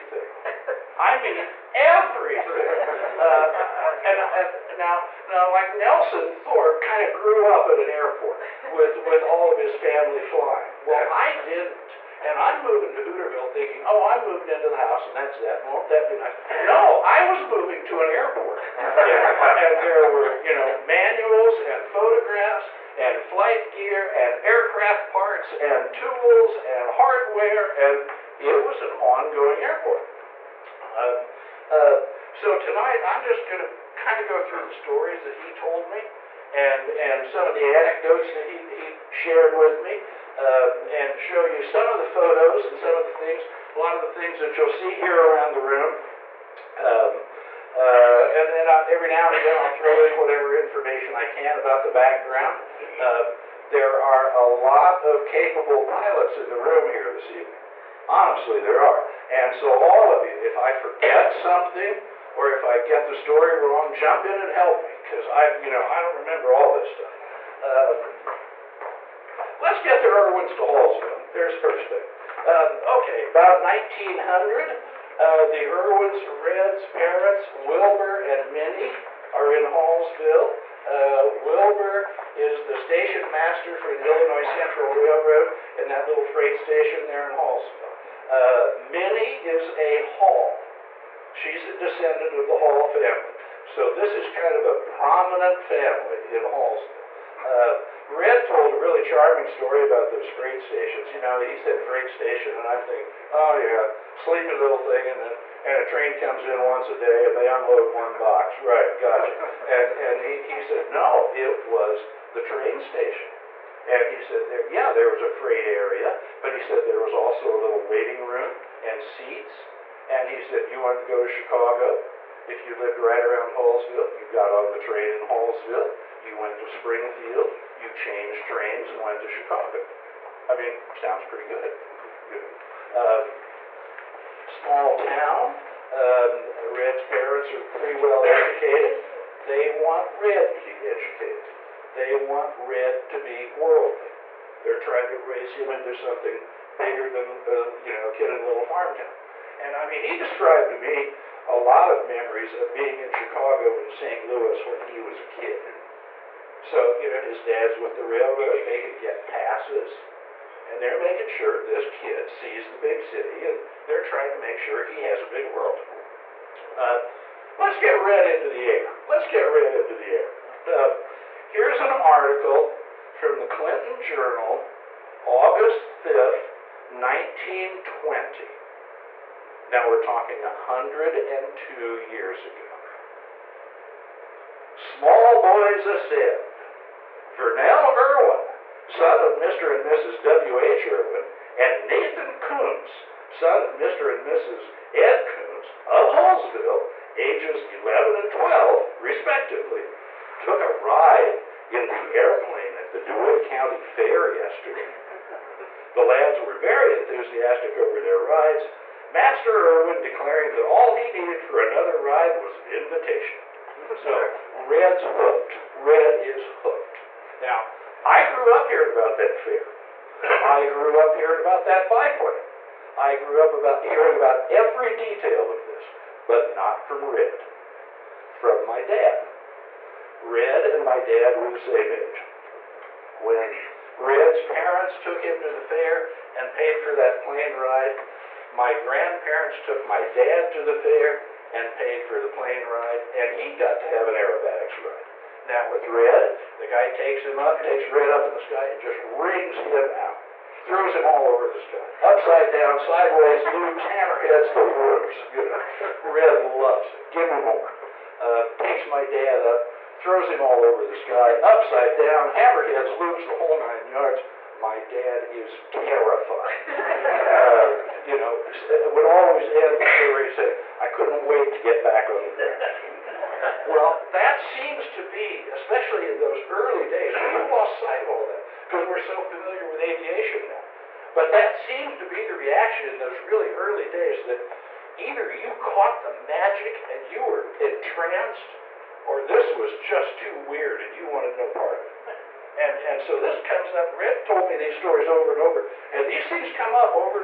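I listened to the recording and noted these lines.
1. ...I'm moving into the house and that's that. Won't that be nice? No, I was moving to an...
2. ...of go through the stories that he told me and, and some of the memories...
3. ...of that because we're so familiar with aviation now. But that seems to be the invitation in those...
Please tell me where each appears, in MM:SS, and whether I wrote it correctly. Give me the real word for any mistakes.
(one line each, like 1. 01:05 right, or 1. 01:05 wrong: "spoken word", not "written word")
1. 00:14 right
2. 00:34 wrong: "anecdotes", not "memories"
3. 04:38 wrong: "reaction", not "invitation".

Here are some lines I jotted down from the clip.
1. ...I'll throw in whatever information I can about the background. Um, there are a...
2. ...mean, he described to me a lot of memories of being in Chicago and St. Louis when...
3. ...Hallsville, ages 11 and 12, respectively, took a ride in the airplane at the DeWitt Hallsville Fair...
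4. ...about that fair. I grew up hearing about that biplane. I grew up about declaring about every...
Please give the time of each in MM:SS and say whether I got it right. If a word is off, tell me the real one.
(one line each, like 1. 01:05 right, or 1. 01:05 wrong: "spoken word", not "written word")
1. 00:49 right
2. 02:29 right
3. 03:16 wrong: "County", not "Hallsville"
4. 03:38 wrong: "hearing", not "declaring".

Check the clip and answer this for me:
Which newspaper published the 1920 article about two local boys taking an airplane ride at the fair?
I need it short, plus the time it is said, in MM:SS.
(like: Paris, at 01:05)
Clinton Journal, at 02:53.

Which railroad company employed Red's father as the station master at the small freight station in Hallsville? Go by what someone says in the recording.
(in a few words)
Illinois Central Railroad.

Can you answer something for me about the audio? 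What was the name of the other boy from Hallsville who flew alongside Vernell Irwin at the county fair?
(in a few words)
Nathan Coons.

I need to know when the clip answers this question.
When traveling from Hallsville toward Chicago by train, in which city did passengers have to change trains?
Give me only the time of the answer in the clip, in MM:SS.
02:06.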